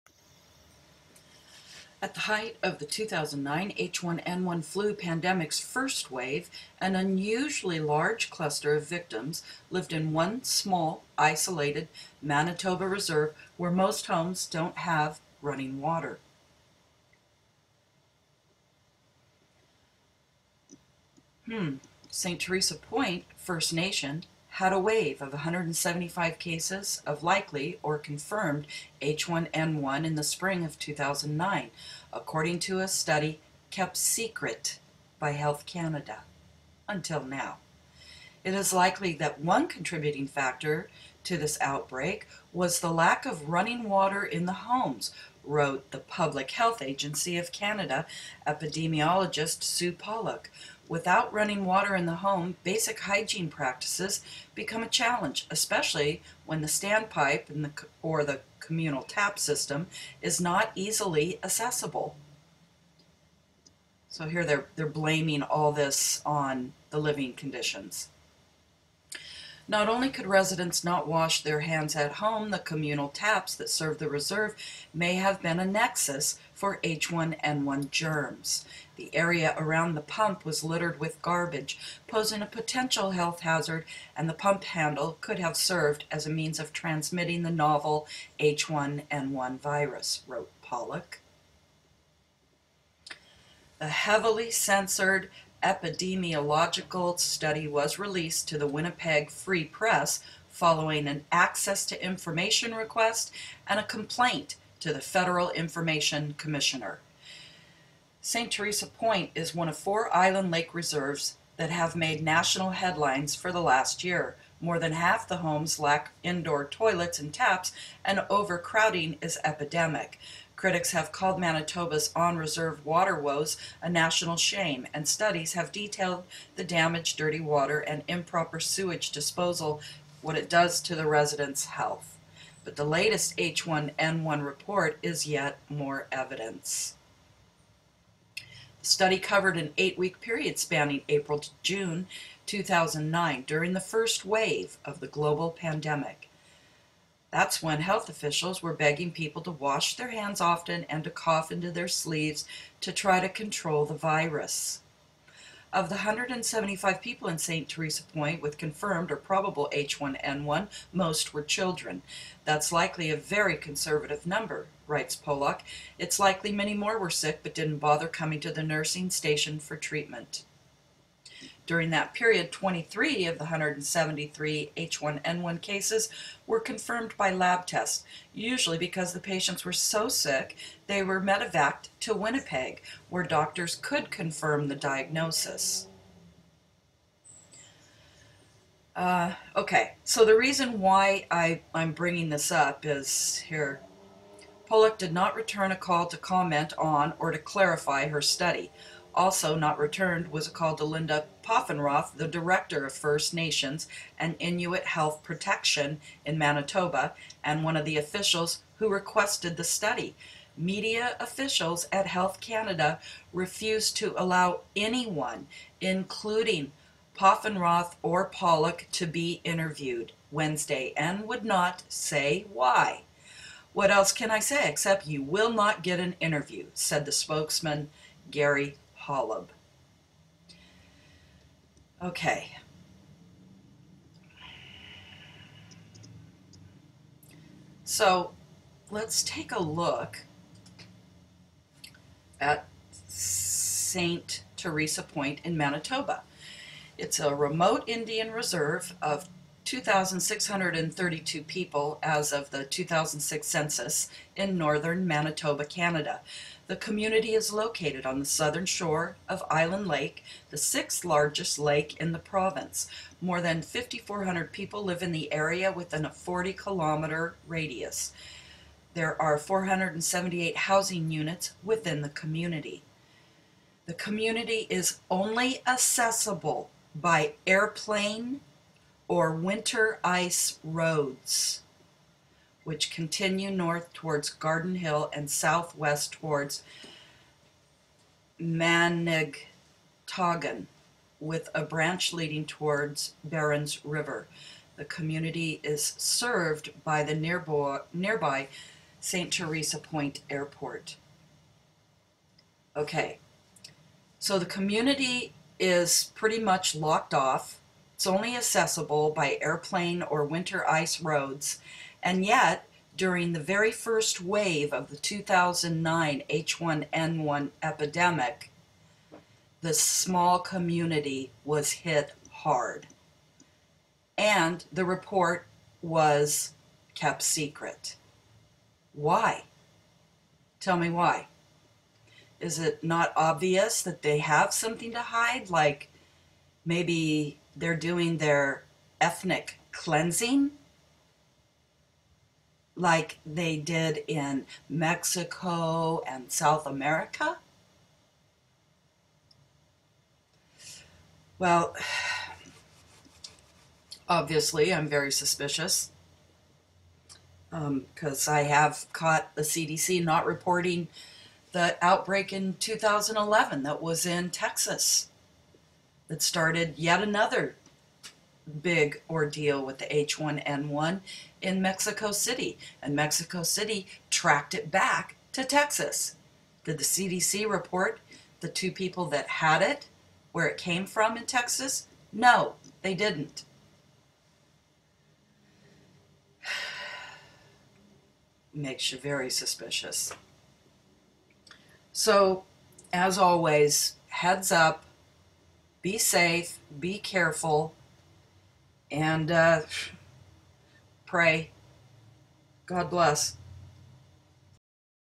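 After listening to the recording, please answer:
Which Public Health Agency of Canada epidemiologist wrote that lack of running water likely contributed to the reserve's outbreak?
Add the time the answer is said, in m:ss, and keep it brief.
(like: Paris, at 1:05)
Sue Pollock, at 0:49.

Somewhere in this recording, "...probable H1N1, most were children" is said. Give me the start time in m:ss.
2:39.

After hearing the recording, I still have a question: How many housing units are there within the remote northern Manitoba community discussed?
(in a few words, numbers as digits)
478.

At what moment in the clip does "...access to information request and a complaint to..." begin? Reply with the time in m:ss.
1:41.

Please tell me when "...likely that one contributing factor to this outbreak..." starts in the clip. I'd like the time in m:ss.
0:38.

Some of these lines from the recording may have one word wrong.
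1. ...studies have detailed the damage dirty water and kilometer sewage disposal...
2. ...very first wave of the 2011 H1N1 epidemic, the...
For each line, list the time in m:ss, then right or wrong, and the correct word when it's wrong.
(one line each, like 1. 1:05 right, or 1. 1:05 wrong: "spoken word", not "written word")
1. 2:05 wrong: "improper", not "kilometer"
2. 5:13 wrong: "2009", not "2011".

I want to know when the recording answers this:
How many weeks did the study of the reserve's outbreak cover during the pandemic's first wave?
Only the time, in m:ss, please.
2:19.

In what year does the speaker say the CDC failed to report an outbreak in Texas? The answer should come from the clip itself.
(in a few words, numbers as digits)
2011.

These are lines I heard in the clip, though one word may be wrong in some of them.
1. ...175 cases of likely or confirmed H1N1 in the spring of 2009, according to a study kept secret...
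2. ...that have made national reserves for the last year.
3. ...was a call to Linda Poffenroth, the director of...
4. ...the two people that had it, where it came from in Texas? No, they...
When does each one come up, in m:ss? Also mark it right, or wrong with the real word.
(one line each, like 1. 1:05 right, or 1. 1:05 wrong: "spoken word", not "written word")
1. 0:25 right
2. 1:51 wrong: "headlines", not "reserves"
3. 3:20 right
4. 6:18 right.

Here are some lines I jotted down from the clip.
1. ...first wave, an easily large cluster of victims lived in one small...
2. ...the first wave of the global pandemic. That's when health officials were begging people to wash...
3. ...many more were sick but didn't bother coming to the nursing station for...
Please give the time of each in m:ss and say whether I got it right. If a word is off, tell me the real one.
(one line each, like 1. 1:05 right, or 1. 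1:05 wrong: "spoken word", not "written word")
1. 0:05 wrong: "unusually", not "easily"
2. 2:23 right
3. 2:46 right.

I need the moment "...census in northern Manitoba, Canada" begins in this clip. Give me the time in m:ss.
4:13.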